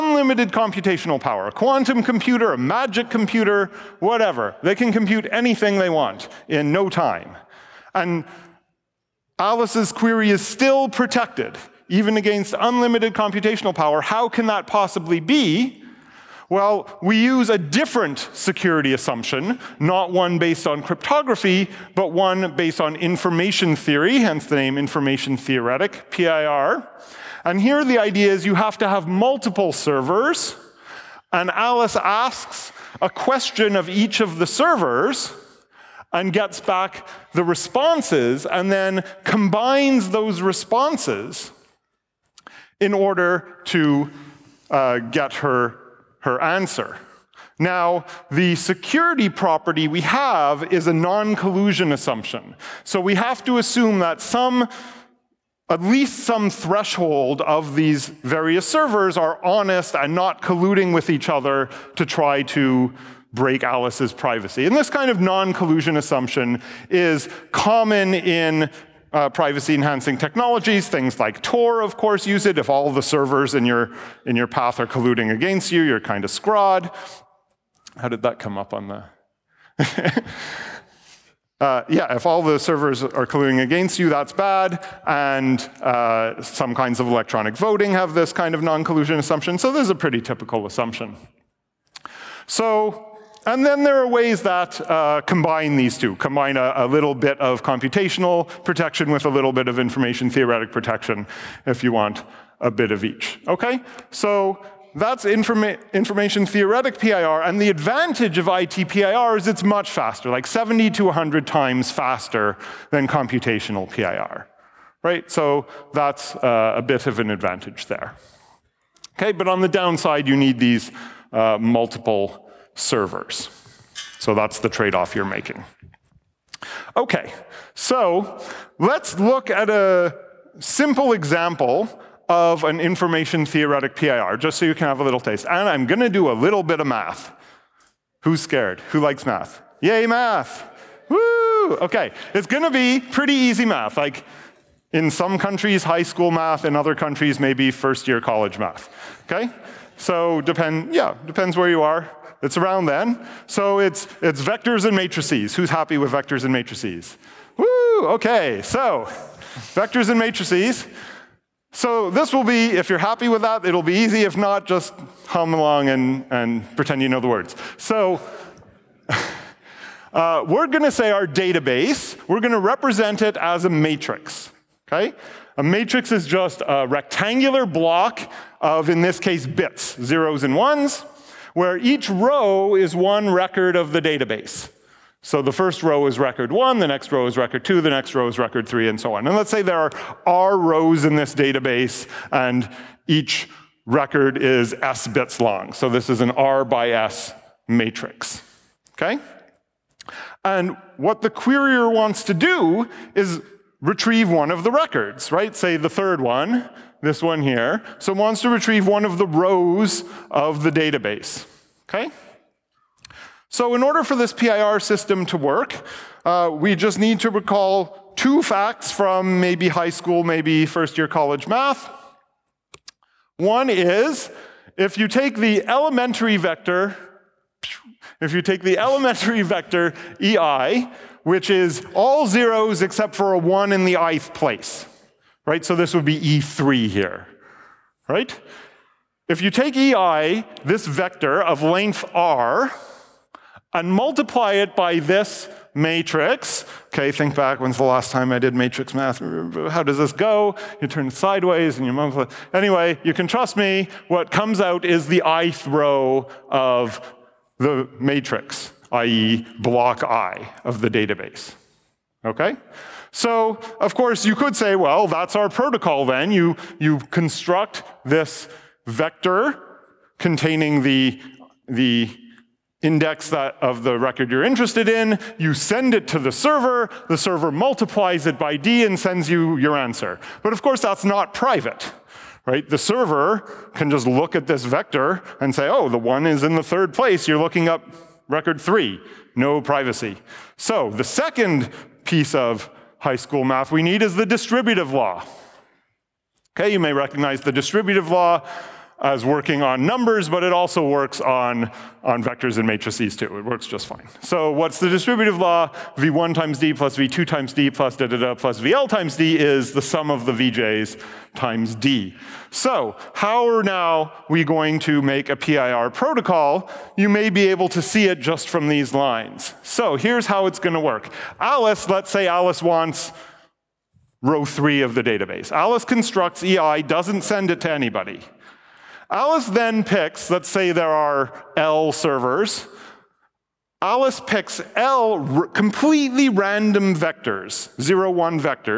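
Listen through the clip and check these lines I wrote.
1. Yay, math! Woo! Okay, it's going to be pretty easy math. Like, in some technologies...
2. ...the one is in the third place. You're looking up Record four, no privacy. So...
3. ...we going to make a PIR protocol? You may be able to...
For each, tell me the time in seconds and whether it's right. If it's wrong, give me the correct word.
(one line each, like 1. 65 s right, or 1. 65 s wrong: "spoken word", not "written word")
1. 139 s wrong: "countries", not "technologies"
2. 285 s wrong: "three", not "four"
3. 314 s right.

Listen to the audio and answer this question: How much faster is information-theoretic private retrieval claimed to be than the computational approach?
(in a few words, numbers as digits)
70 to 100.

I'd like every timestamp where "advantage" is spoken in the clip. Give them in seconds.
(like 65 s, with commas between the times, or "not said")
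107 s, 117 s.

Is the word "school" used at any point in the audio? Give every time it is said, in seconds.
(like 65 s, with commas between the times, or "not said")
146 s, 219 s, 293 s.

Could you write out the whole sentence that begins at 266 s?
You, you construct this vector containing the, the index that of the record you're interested in.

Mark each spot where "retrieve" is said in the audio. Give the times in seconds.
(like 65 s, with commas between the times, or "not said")
203 s, 208 s.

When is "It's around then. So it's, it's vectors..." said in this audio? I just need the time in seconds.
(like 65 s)
152 s.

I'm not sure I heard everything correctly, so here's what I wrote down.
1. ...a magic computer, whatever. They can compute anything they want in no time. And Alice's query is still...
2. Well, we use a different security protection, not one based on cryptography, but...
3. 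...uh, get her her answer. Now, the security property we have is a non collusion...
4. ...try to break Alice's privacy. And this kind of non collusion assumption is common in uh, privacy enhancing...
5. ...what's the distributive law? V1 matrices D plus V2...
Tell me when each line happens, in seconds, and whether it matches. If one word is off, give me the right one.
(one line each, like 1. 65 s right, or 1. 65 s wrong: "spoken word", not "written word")
1. 2 s right
2. 16 s wrong: "assumption", not "protection"
3. 44 s right
4. 62 s right
5. 304 s wrong: "times", not "matrices".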